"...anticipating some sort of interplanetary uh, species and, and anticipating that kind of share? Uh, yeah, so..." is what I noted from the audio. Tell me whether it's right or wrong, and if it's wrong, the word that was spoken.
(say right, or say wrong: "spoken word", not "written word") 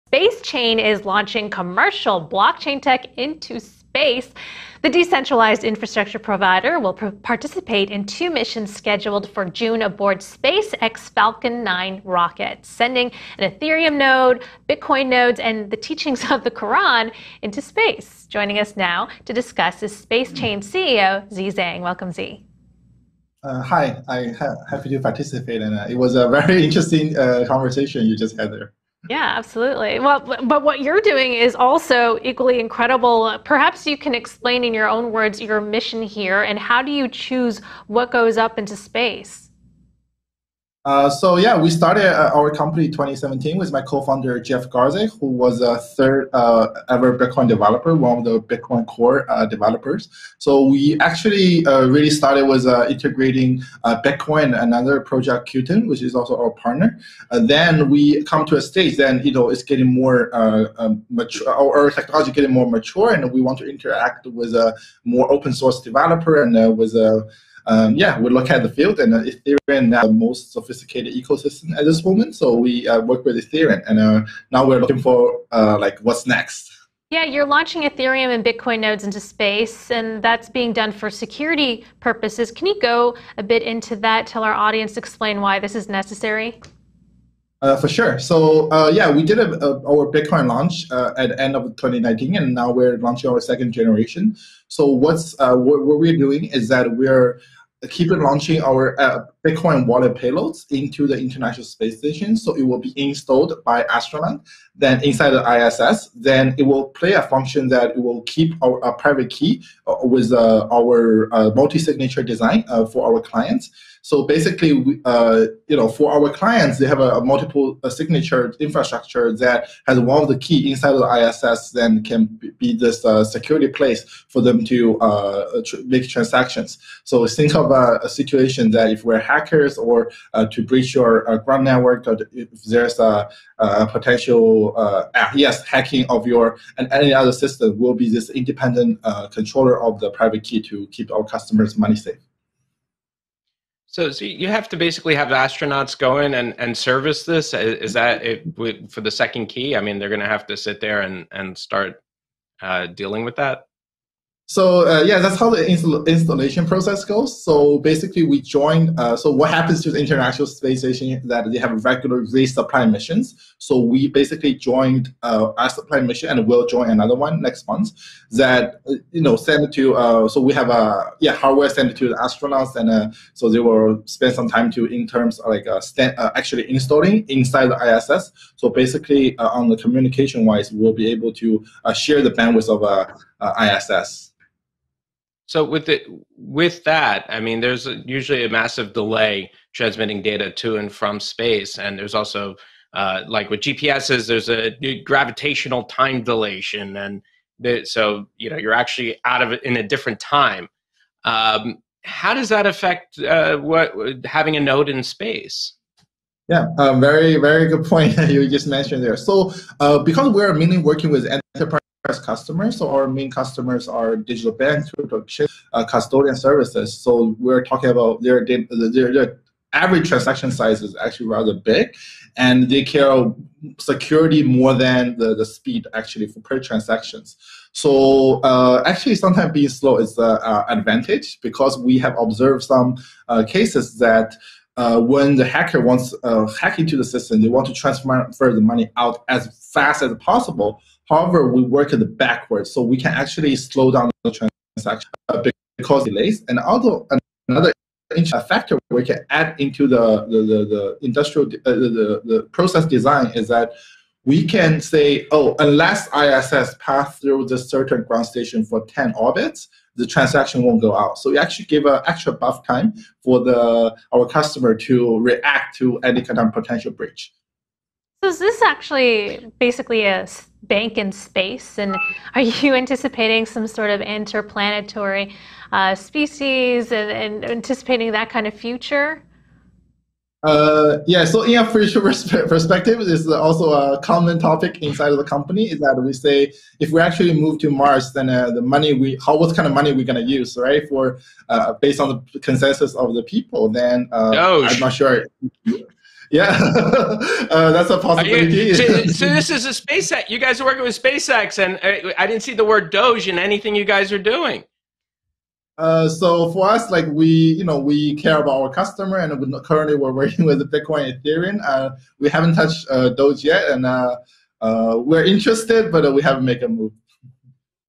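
wrong: "future", not "share".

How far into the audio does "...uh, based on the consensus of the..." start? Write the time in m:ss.
4:51.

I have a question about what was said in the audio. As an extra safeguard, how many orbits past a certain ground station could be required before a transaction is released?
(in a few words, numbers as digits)
10.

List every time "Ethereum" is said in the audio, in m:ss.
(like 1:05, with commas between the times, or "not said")
0:13, 1:09, 1:13, 1:17, 5:11.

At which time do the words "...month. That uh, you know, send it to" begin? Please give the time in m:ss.
2:47.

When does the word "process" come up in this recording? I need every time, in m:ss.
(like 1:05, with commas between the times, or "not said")
2:36, 4:12.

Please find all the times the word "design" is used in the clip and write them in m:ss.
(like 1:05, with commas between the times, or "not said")
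1:52, 4:12.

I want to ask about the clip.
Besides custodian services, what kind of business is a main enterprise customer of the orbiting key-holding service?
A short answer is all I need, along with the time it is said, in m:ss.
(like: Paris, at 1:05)
Digital banks, at 3:34.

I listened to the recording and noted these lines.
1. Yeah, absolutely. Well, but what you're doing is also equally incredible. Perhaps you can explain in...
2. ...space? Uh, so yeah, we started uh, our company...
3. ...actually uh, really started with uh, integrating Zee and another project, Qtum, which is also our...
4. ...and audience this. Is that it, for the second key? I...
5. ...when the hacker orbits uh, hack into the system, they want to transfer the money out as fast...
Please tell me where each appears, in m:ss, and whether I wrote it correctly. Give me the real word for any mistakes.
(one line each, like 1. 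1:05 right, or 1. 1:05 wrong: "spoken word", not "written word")
1. 0:29 right
2. 0:38 right
3. 0:50 wrong: "Bitcoin", not "Zee"
4. 2:26 wrong: "service", not "audience"
5. 3:54 wrong: "wants", not "orbits".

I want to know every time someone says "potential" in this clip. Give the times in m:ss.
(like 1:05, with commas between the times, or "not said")
2:13, 4:26.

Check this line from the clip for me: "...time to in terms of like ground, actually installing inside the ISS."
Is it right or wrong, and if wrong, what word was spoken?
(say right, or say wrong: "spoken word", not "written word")
wrong: "stand", not "ground".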